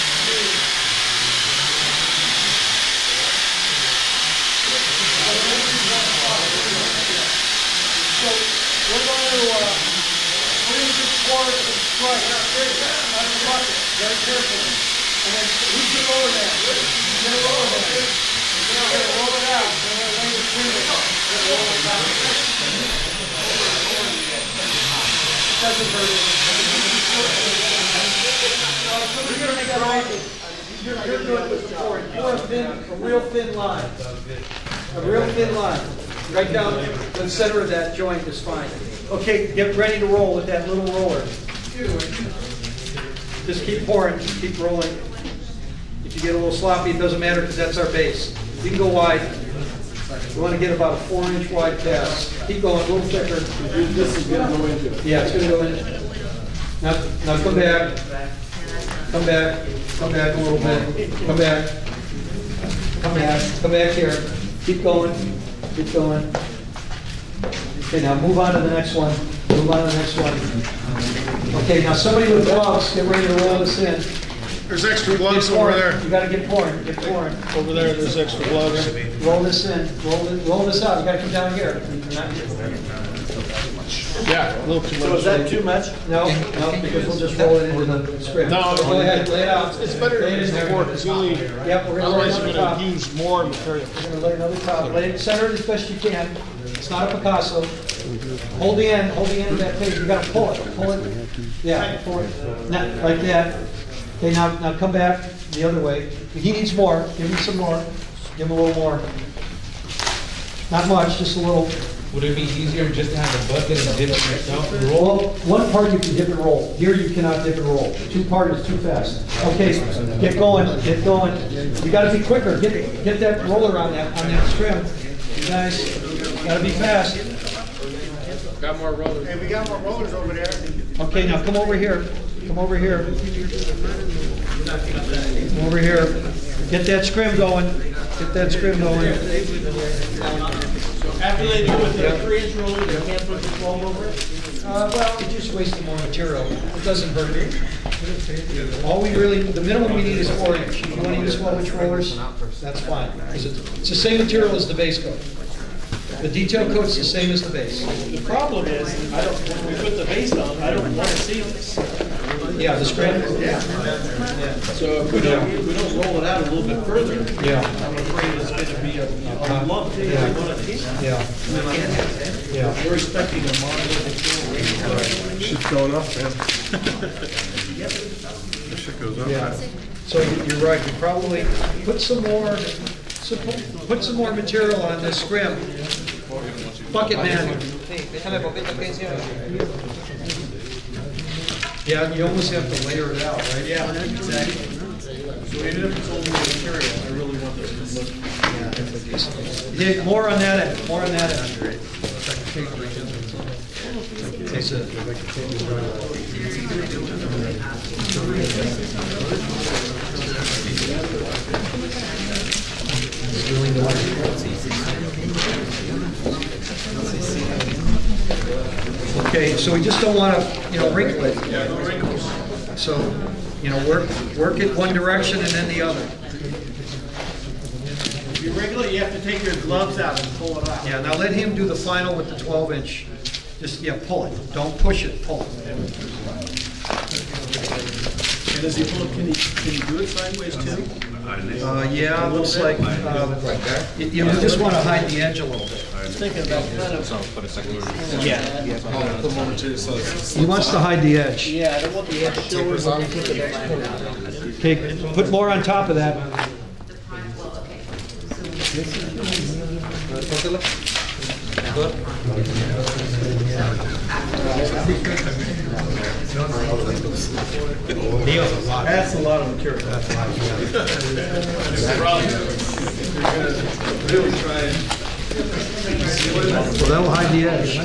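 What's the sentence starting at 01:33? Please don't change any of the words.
We're gonna lay another top, lay it as best you can.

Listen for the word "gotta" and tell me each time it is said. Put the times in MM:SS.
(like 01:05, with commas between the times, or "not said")
01:16, 01:21, 01:40, 02:01, 02:06.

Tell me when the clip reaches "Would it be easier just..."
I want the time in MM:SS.
01:52.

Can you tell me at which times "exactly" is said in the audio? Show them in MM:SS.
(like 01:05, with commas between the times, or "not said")
03:14.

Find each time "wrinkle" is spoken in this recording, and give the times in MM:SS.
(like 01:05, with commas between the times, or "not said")
03:40, 03:48.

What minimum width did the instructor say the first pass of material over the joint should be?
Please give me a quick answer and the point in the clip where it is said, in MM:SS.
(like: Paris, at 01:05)
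4 inch, at 00:51.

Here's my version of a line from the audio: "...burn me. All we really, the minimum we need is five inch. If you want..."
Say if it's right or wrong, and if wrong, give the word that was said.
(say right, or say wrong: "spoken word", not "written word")
wrong: "four", not "five".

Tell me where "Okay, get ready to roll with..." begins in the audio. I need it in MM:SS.
00:39.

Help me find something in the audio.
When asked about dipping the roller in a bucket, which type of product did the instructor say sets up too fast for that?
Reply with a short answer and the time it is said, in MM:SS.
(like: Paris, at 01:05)
Two part, at 01:58.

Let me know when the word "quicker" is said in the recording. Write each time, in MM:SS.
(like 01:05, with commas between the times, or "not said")
02:02.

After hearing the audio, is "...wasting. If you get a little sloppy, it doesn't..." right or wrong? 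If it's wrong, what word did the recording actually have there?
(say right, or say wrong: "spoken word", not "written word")
wrong: "rolling", not "wasting".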